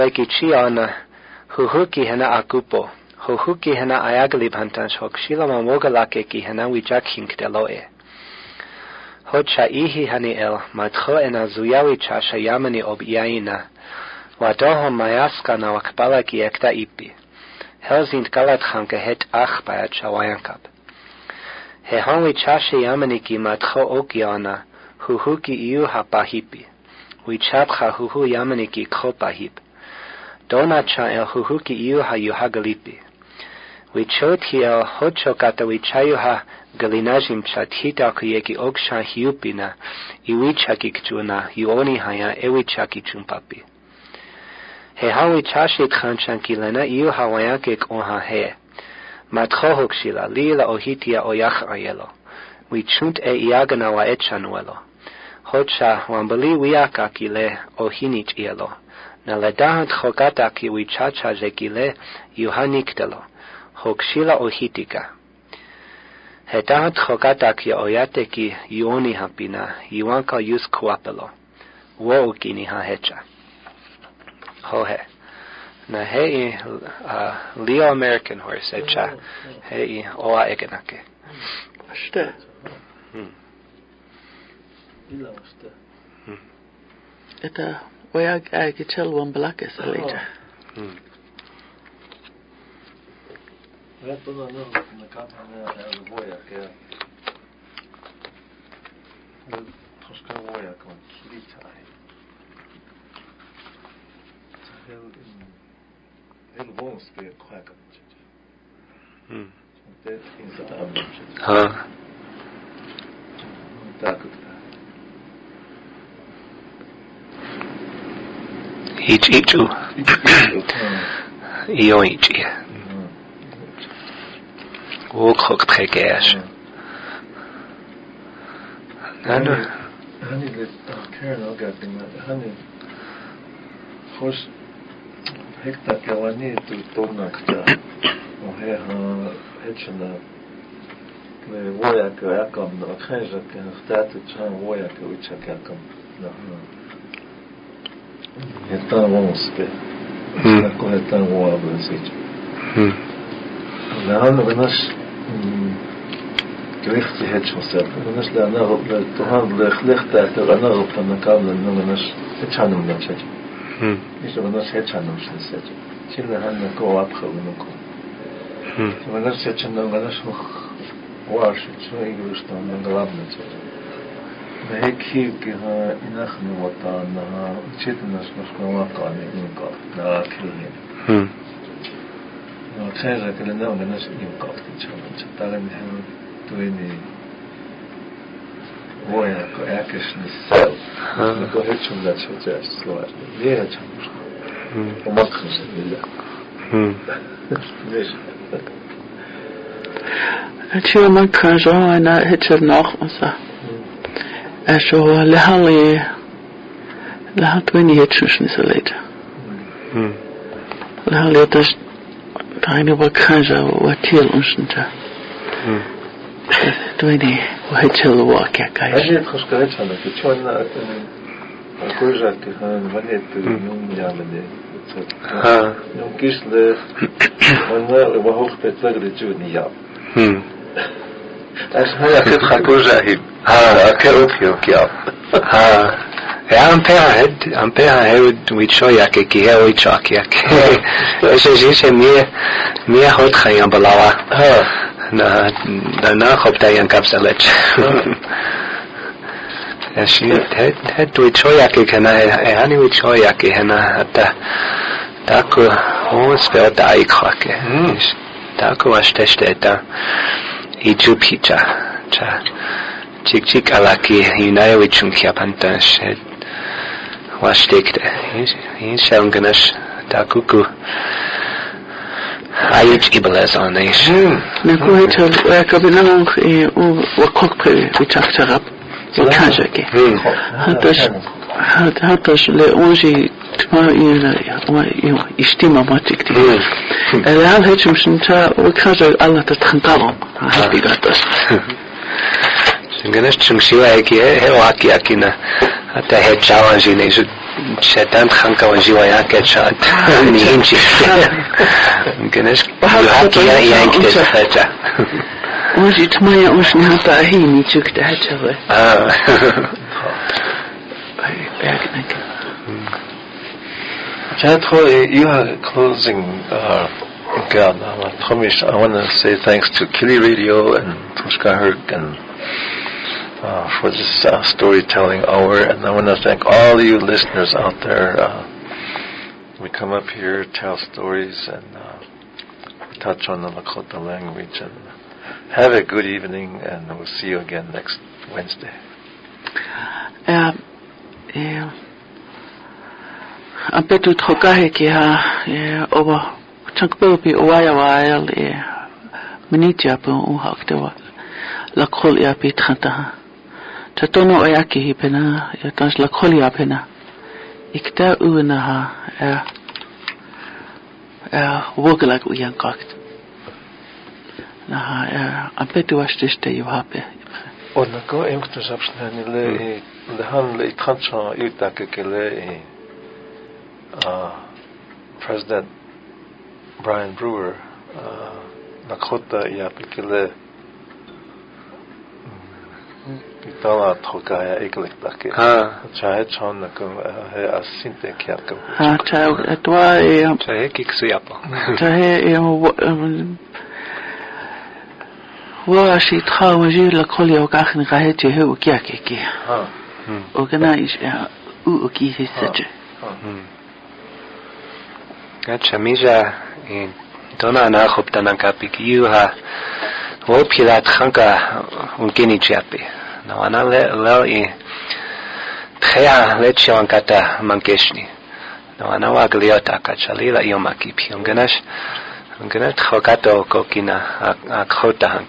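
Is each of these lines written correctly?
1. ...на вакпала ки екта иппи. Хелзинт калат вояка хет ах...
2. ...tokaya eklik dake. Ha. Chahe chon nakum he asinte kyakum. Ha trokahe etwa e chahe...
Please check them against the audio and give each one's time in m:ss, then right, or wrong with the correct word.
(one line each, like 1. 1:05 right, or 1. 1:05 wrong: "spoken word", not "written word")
1. 0:15 wrong: "ханка", not "вояка"
2. 6:23 wrong: "chahe", not "trokahe".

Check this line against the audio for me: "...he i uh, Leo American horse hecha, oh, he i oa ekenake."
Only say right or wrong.
right.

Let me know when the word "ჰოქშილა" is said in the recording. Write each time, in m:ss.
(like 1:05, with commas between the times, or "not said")
0:49, 1:03.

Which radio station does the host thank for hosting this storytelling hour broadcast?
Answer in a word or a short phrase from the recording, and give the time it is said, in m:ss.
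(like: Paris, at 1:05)
Kili Radio, at 5:19.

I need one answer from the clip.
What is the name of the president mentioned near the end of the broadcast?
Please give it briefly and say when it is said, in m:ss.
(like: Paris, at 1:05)
Brian Brewer, at 6:16.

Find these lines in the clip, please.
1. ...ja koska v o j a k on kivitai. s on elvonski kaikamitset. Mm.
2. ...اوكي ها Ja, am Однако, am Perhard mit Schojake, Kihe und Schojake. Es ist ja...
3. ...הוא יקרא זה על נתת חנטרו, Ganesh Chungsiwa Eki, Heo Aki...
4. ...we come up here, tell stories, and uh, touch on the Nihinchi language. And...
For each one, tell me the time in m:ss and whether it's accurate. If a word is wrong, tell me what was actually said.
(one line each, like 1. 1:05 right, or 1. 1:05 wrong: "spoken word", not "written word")
1. 1:39 right
2. 3:54 wrong: "Perhard", not "Однако"
3. 4:48 right
4. 5:29 wrong: "Lakota", not "Nihinchi".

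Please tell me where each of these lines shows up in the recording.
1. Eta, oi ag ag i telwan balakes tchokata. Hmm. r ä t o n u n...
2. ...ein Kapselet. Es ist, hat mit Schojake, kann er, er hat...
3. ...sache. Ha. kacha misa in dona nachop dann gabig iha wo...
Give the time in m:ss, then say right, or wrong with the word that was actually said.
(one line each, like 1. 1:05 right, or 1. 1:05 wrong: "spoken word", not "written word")
1. 1:27 wrong: "alita", not "tchokata"
2. 4:06 right
3. 6:42 wrong: "gacha", not "kacha".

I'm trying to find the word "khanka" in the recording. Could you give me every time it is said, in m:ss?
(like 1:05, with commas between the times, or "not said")
4:58, 6:50.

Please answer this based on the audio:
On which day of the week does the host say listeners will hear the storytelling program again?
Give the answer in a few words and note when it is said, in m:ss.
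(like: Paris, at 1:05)
Wednesday, at 5:38.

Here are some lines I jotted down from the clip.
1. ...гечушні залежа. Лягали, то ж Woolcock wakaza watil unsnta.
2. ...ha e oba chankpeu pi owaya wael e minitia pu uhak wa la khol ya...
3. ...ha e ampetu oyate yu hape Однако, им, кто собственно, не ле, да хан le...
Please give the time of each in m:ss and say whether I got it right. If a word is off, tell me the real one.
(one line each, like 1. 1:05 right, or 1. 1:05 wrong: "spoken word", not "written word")
1. 3:27 wrong: "Tani", not "Woolcock"
2. 5:44 right
3. 6:04 wrong: "washtiste", not "oyate".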